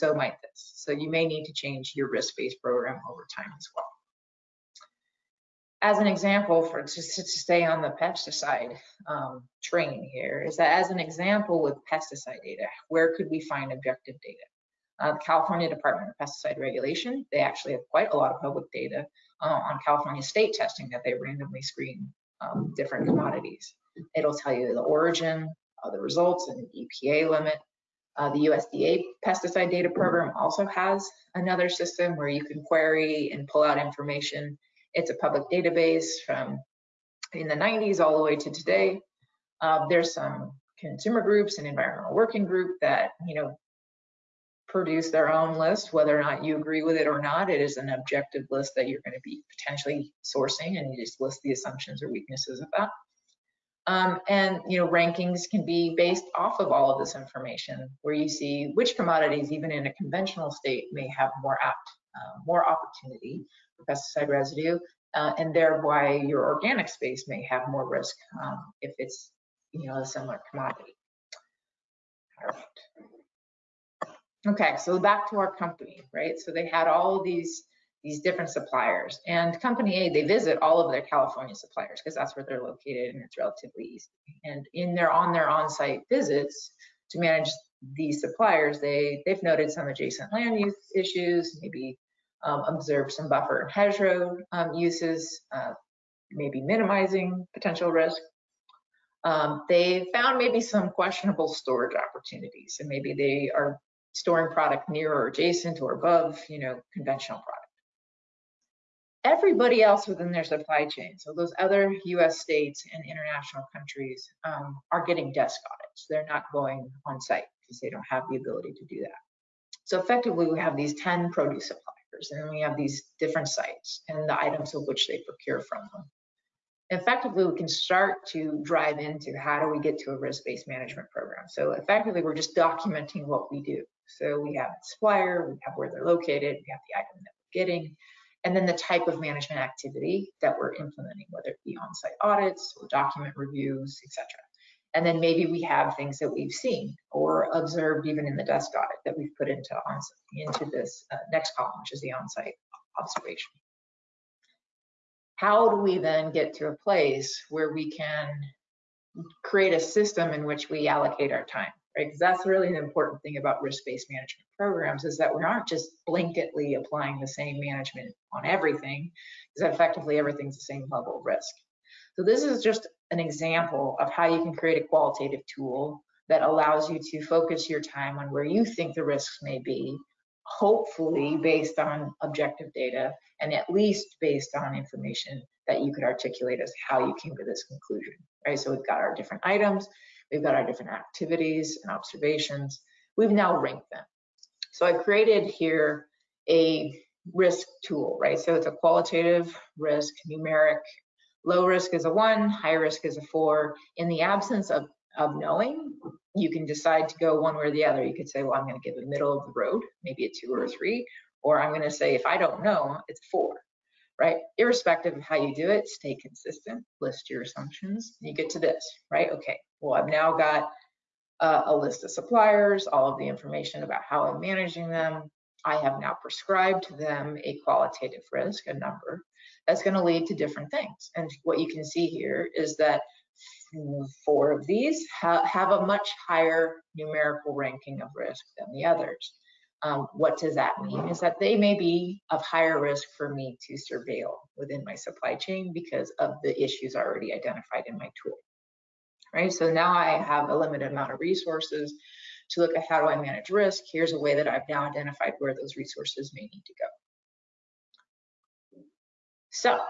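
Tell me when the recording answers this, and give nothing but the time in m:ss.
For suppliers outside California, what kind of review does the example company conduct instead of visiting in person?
1:55.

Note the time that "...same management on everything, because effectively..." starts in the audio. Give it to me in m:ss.
2:47.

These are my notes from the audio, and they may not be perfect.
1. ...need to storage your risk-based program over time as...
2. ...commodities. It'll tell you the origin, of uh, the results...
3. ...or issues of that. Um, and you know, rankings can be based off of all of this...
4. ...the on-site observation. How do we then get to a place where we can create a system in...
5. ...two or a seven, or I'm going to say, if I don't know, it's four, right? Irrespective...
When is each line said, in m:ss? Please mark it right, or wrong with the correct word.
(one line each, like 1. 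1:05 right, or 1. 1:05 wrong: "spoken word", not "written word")
1. 0:01 wrong: "change", not "storage"
2. 0:23 right
3. 0:52 wrong: "weaknesses", not "issues"
4. 2:32 right
5. 3:30 wrong: "three", not "seven".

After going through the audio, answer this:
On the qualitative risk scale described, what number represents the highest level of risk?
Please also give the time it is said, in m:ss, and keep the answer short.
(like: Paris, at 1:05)
4, at 3:22.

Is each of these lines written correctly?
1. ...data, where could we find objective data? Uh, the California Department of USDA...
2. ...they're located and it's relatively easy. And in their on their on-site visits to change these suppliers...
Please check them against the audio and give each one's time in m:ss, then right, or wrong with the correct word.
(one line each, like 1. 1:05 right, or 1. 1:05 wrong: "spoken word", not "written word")
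1. 0:12 wrong: "Pesticide", not "USDA"
2. 1:22 wrong: "manage", not "change".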